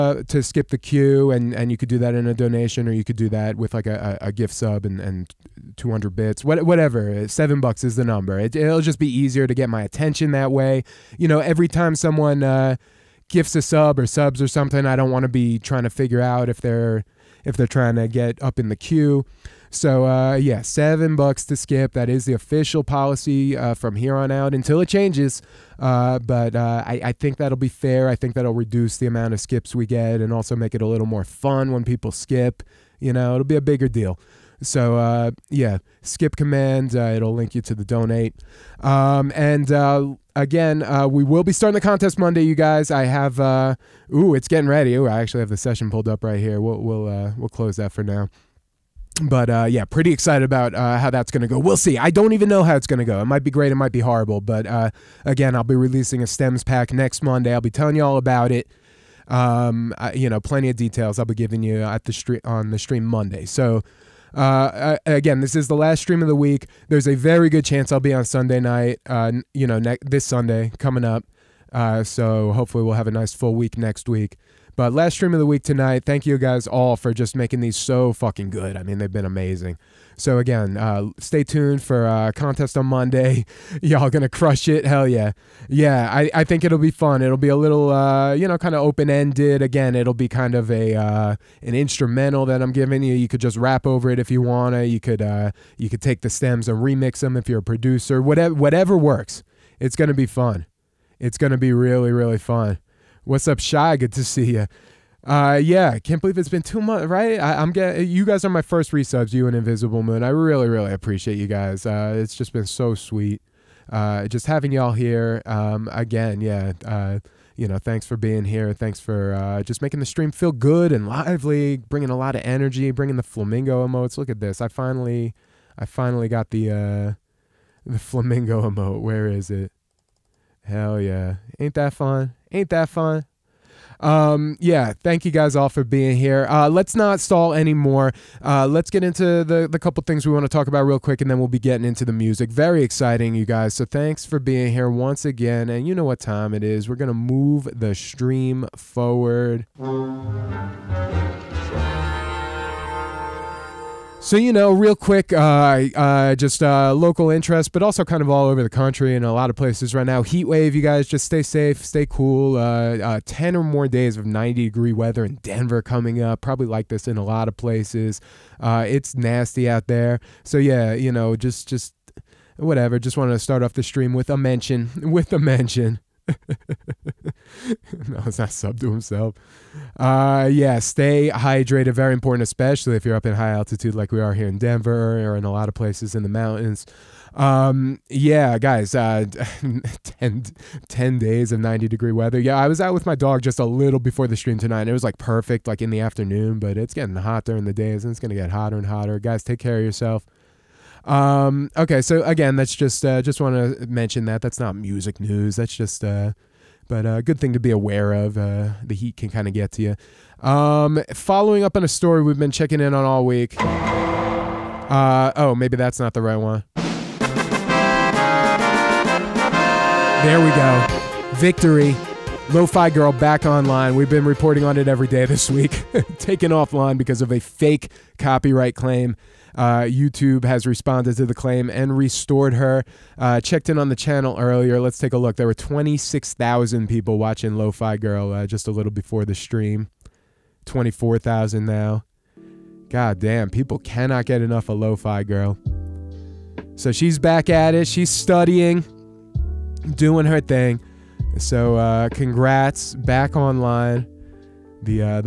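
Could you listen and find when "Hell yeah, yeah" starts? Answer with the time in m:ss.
1:24.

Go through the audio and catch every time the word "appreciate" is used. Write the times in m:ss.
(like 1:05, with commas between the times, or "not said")
1:50.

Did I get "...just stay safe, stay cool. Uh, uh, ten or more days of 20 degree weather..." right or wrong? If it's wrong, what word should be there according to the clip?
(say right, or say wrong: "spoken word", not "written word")
wrong: "90", not "20".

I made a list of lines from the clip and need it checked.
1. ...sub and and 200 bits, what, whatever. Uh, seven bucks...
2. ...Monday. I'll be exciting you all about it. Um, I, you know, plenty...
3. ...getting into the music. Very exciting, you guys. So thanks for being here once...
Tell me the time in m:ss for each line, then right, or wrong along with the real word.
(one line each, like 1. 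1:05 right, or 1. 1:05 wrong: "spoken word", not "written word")
1. 0:04 right
2. 0:57 wrong: "telling", not "exciting"
3. 2:21 right.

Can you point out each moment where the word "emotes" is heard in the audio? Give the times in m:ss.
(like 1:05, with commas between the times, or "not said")
2:03, 2:08.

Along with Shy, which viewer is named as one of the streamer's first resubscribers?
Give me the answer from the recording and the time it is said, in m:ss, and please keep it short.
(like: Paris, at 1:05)
Invisible Moon, at 1:49.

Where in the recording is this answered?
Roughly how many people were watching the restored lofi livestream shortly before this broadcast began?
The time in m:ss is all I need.
3:55.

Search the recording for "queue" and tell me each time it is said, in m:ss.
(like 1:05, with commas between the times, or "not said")
0:00, 0:18.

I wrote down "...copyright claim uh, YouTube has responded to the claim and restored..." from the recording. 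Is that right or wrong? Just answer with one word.
right.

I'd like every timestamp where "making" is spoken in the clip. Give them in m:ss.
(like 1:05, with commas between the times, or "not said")
1:17, 1:59.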